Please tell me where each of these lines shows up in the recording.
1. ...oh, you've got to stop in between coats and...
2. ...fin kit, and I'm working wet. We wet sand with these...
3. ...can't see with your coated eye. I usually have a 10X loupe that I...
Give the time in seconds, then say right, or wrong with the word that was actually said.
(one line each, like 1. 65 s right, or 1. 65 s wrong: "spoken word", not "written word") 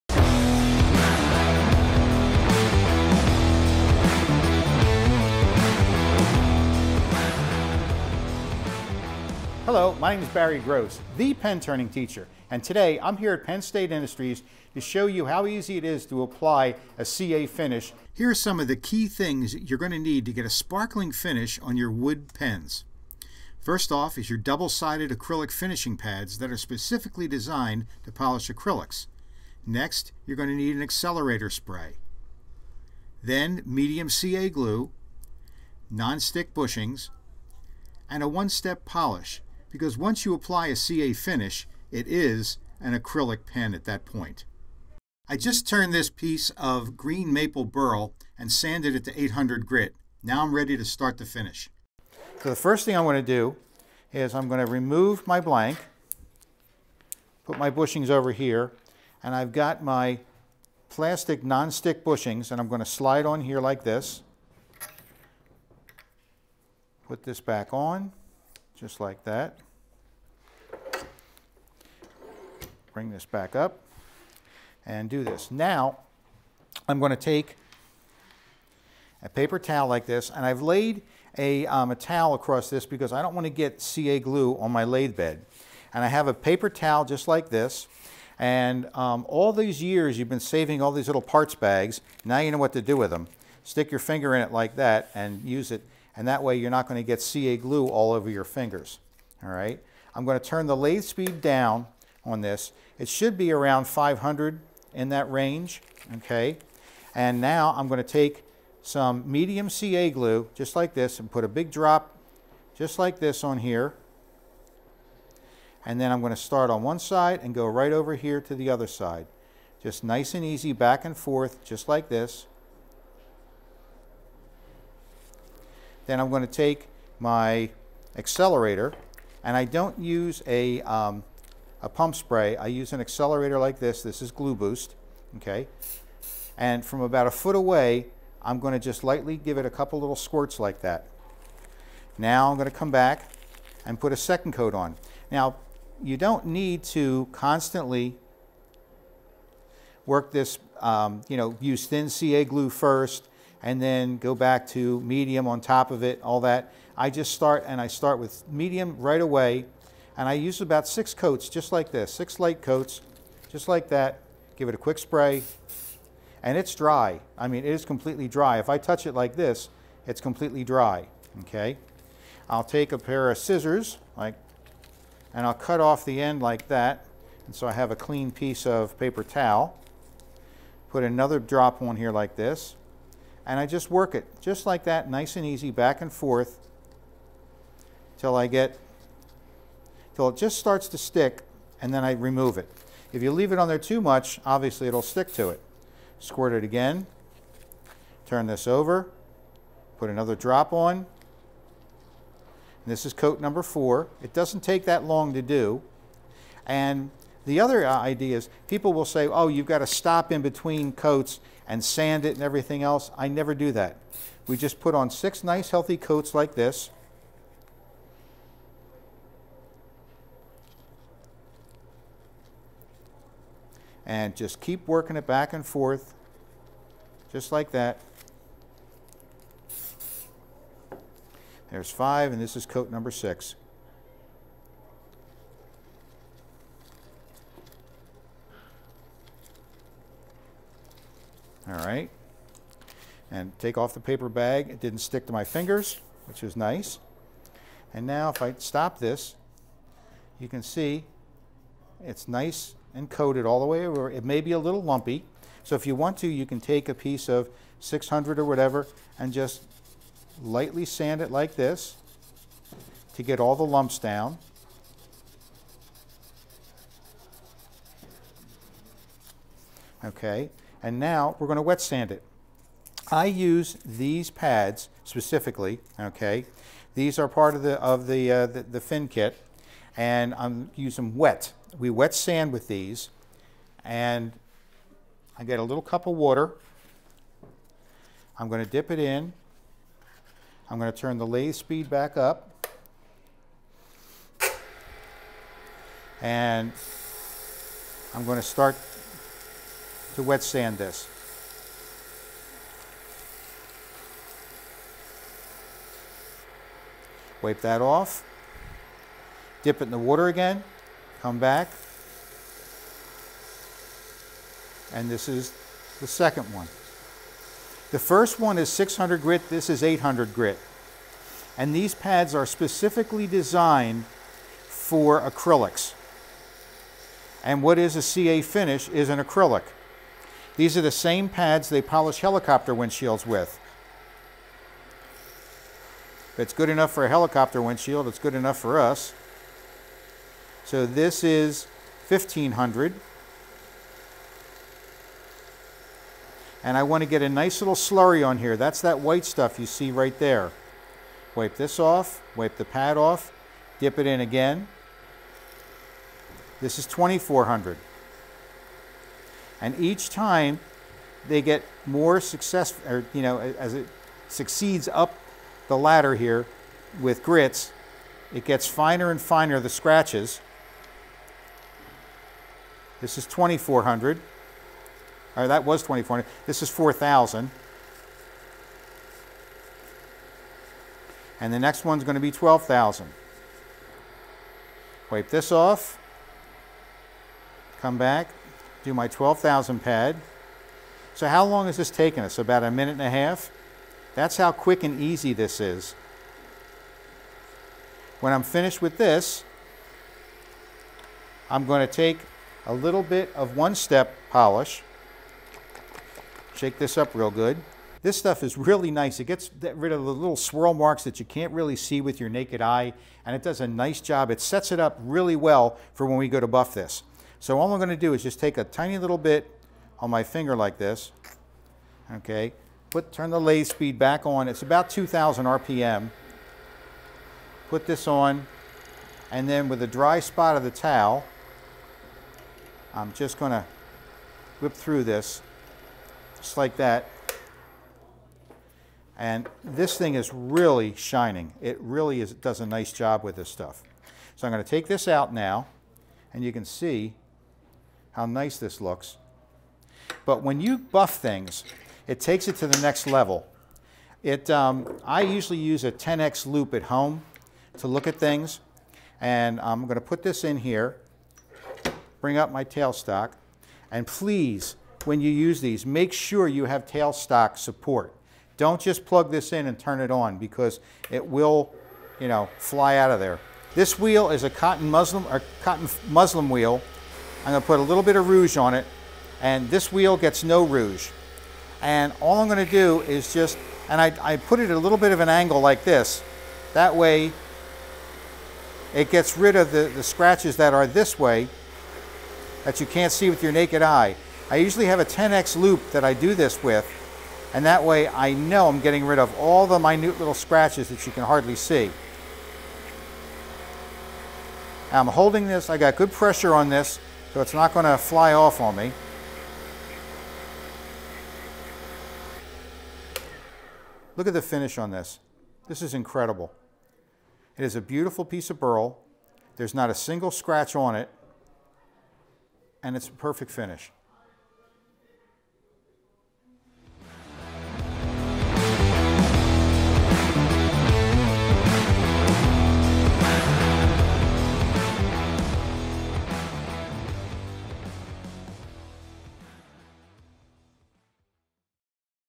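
1. 209 s right
2. 278 s wrong: "using", not "working"
3. 492 s wrong: "naked", not "coated".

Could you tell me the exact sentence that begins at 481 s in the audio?
And all I'm going to do is just, and I, I put it at a little bit of an angle like this.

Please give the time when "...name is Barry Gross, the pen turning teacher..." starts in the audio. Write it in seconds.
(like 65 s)
10 s.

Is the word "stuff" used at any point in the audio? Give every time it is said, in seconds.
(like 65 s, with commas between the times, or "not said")
349 s, 408 s, 443 s.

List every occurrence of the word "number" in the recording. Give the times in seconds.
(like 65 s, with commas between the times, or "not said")
203 s, 232 s.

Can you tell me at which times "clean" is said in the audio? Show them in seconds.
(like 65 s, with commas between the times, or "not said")
177 s.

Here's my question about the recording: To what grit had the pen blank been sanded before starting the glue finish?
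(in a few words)
800.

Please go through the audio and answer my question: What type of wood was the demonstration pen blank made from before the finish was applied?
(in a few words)
green maple burl.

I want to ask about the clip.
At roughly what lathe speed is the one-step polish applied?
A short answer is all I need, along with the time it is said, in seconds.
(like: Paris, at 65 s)
2,000 RPM, at 424 s.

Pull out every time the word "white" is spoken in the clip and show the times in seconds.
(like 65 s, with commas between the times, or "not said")
348 s.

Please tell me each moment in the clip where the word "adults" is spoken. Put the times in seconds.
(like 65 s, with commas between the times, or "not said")
not said.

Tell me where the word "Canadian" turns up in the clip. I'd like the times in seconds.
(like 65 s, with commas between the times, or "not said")
not said.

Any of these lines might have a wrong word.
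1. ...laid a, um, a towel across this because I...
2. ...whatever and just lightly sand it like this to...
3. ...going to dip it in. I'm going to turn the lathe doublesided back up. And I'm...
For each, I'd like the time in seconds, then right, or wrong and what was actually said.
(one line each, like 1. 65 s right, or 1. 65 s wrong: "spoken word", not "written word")
1. 80 s right
2. 258 s right
3. 288 s wrong: "speed", not "doublesided".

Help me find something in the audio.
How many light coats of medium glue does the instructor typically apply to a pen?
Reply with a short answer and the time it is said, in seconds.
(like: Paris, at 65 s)
6, at 162 s.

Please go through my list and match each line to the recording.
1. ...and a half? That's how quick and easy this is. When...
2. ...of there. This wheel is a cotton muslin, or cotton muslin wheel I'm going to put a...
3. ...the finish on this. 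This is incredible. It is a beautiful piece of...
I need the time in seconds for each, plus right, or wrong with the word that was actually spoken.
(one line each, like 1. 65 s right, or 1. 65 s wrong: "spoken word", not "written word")
1. 392 s right
2. 473 s right
3. 514 s right.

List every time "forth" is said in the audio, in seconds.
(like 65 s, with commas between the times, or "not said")
121 s, 186 s, 225 s.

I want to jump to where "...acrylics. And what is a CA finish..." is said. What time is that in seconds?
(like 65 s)
325 s.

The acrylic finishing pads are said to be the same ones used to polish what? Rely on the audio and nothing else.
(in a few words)
helicopter windshields.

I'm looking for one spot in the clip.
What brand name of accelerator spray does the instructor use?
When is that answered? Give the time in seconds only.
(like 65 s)
134 s.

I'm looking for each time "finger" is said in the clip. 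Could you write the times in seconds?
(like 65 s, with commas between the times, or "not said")
93 s, 98 s, 245 s, 420 s.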